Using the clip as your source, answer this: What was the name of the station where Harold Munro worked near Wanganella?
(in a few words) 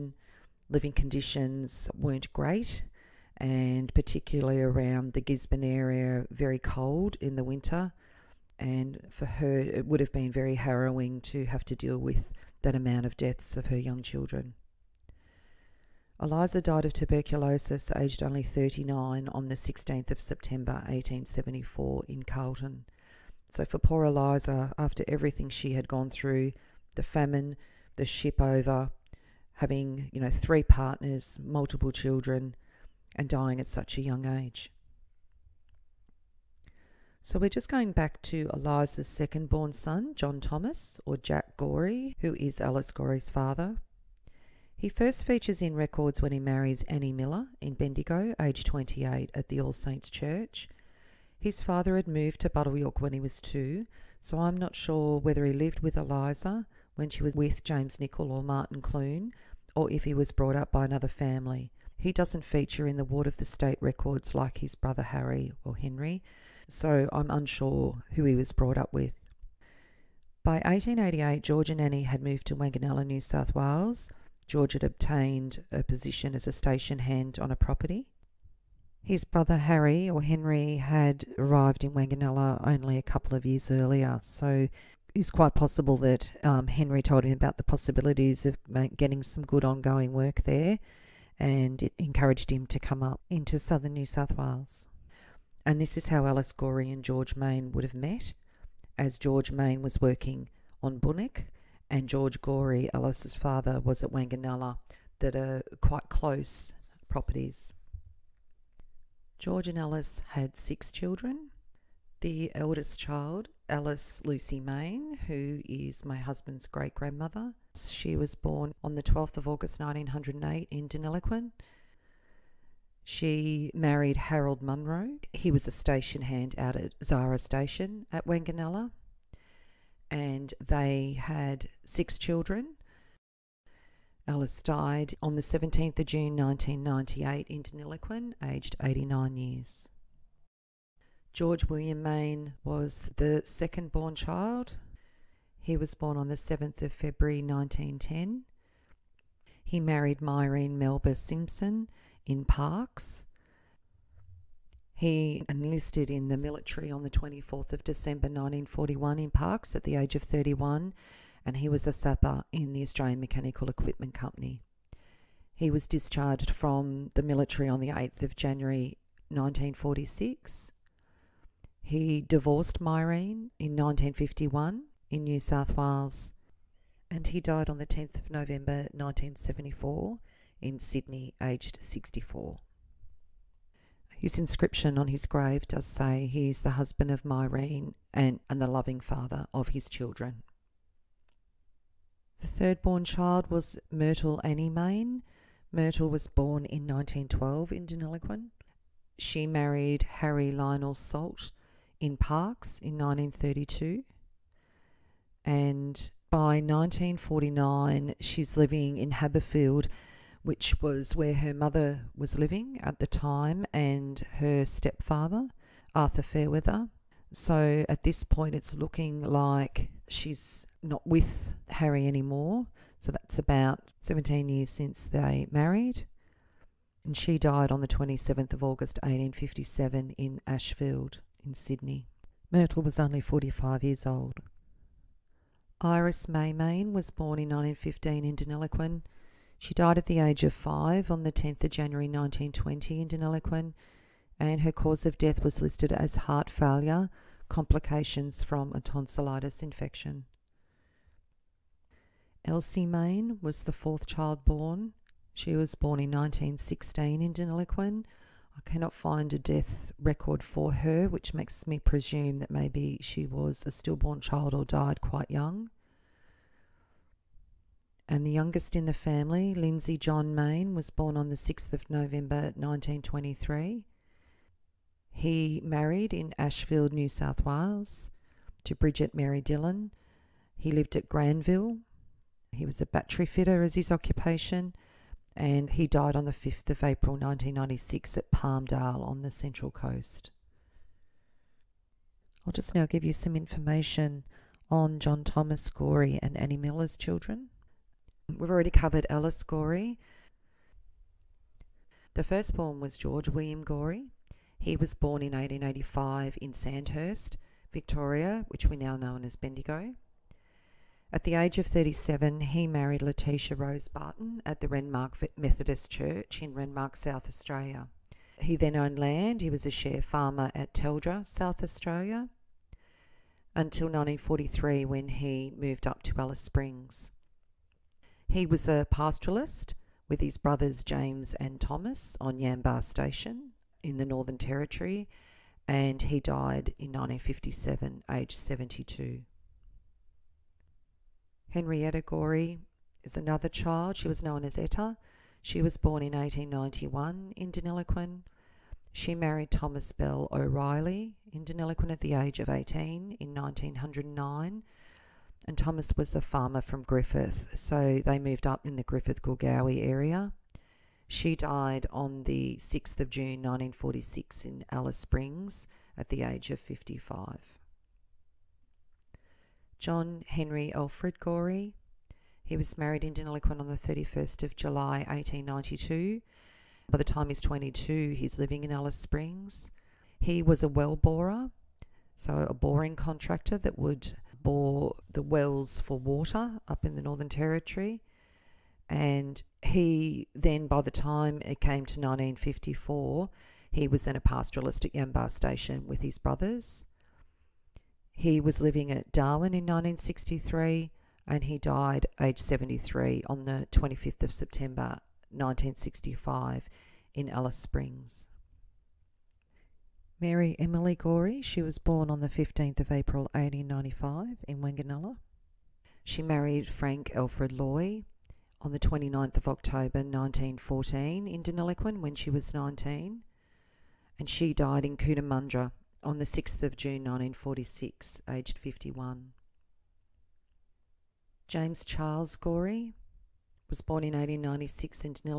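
Zara Station.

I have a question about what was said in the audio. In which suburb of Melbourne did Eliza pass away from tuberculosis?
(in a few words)
Carlton.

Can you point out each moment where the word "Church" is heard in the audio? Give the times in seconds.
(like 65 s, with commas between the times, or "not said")
50 s, 315 s.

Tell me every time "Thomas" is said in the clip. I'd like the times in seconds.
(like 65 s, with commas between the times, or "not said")
40 s, 295 s, 331 s, 349 s, 355 s.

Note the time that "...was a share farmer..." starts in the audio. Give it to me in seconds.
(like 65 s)
319 s.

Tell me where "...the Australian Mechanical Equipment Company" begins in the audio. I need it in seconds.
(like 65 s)
162 s.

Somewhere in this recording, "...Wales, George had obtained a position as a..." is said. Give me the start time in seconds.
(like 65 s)
73 s.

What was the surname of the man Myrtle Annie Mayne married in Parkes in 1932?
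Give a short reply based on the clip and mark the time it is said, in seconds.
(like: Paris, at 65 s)
Salt, at 200 s.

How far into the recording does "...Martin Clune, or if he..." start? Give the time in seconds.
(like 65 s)
58 s.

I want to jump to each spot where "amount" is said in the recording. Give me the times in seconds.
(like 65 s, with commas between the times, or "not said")
12 s.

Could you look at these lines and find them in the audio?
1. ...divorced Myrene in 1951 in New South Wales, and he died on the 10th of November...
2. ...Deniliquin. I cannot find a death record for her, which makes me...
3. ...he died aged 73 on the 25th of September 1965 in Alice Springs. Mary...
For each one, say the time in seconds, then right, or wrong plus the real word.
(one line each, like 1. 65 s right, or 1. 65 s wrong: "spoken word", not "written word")
1. 172 s right
2. 257 s right
3. 401 s right.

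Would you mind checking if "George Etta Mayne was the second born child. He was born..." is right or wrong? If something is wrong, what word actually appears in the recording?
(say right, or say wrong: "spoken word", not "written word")
wrong: "William", not "Etta".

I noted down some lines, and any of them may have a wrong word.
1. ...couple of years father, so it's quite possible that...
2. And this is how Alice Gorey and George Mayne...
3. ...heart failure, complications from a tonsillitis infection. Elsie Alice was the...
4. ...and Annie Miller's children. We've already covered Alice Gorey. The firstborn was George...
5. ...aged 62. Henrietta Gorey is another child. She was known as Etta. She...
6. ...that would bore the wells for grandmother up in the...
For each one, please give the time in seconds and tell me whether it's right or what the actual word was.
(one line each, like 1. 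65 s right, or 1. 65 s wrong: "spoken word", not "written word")
1. 83 s wrong: "earlier", not "father"
2. 95 s right
3. 246 s wrong: "Mayne", not "Alice"
4. 296 s right
5. 338 s wrong: "72", not "62"
6. 383 s wrong: "water", not "grandmother".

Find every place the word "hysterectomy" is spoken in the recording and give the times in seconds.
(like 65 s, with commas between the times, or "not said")
not said.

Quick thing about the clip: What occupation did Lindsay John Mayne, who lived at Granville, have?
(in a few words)
Battery fitter.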